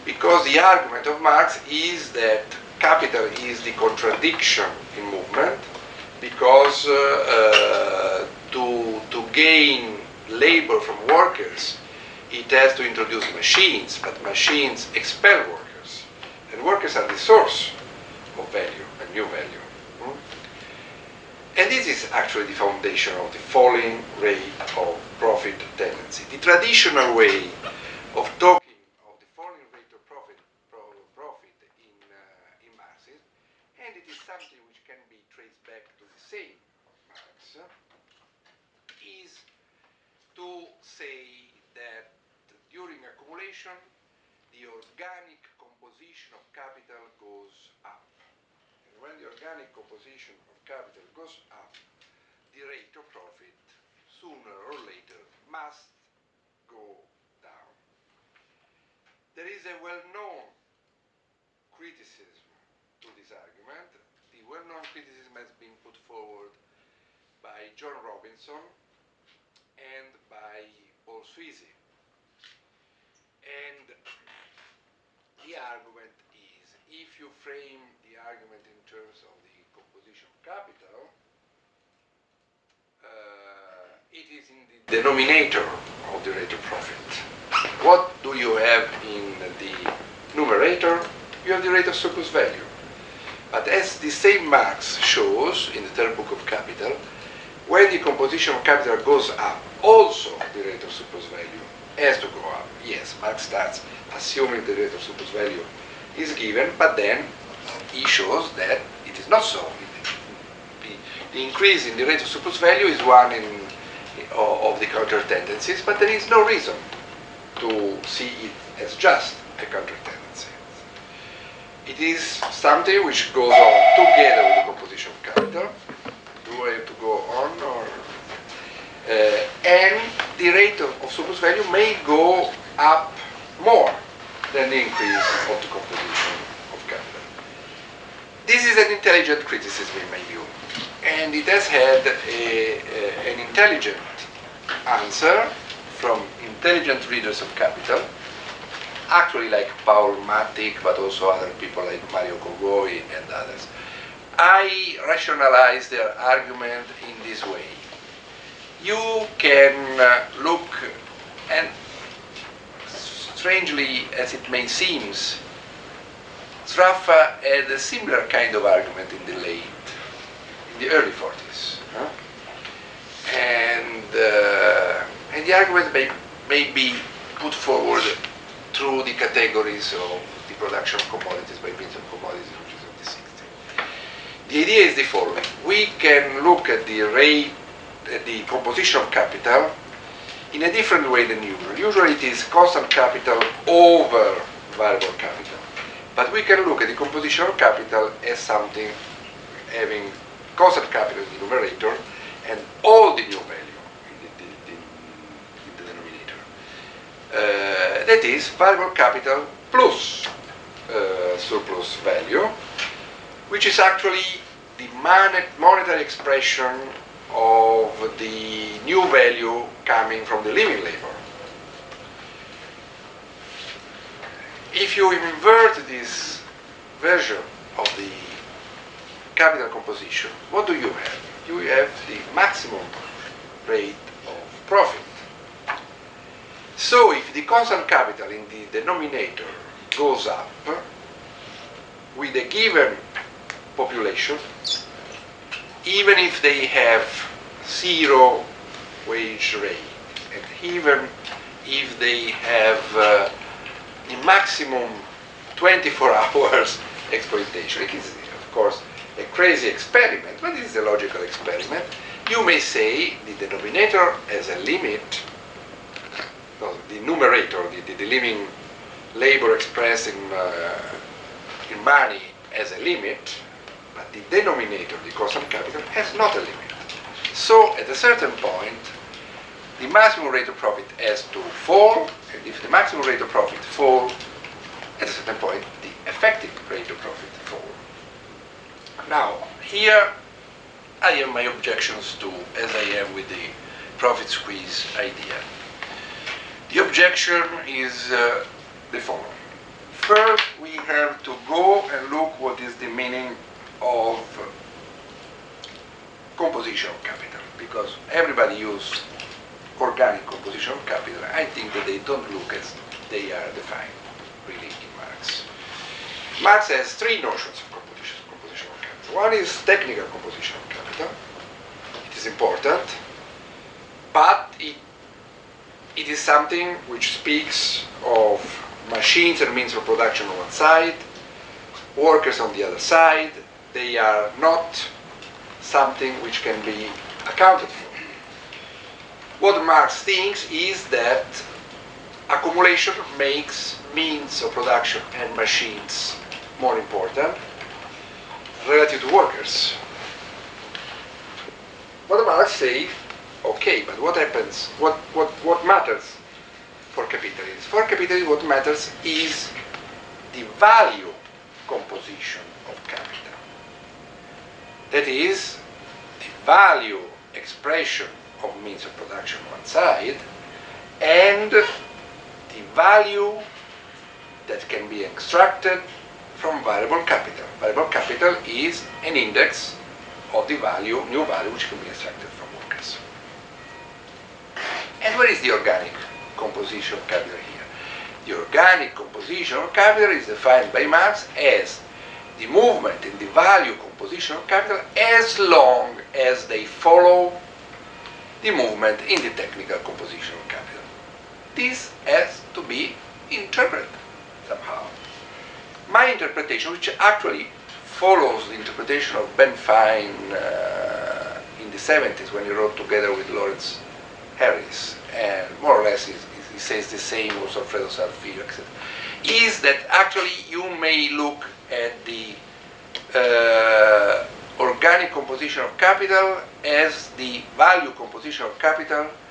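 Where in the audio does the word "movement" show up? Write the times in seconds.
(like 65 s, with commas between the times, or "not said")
5 s, 392 s, 398 s.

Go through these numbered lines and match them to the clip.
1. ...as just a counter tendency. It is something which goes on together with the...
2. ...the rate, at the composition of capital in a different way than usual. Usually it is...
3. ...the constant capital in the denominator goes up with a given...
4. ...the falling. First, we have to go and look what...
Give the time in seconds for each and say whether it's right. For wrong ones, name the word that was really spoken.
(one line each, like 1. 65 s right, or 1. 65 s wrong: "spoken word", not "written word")
1. 118 s right
2. 186 s right
3. 237 s right
4. 298 s wrong: "following", not "falling".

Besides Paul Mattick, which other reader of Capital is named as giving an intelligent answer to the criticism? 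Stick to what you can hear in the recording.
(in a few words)
Mario Cogoy.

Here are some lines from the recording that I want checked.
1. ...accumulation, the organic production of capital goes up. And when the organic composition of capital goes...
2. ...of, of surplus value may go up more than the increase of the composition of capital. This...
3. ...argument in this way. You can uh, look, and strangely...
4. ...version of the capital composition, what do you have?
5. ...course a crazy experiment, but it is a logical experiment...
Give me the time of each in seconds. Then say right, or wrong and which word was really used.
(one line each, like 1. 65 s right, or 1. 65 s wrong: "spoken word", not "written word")
1. 43 s wrong: "composition", not "production"
2. 130 s right
3. 156 s right
4. 227 s right
5. 258 s right.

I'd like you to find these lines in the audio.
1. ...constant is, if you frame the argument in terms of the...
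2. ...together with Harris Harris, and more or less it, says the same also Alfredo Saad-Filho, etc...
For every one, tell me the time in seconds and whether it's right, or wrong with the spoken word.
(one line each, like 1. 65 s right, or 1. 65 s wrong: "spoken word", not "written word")
1. 75 s wrong: "argument", not "constant"
2. 412 s wrong: "Lawrence", not "Harris".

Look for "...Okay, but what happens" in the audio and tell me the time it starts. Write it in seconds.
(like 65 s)
353 s.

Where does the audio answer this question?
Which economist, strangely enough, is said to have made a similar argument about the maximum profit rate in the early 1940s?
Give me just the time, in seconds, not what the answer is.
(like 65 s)
166 s.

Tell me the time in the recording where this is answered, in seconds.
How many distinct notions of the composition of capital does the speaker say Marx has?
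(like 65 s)
316 s.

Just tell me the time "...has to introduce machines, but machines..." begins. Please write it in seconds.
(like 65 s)
12 s.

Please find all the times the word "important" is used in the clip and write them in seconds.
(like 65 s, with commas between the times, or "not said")
322 s, 346 s.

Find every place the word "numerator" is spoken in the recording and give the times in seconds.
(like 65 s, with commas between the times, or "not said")
90 s, 201 s, 267 s.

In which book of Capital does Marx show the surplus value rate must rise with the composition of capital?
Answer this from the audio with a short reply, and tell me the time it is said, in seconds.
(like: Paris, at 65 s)
third book, at 95 s.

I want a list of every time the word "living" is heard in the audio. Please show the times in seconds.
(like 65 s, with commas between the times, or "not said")
220 s, 268 s.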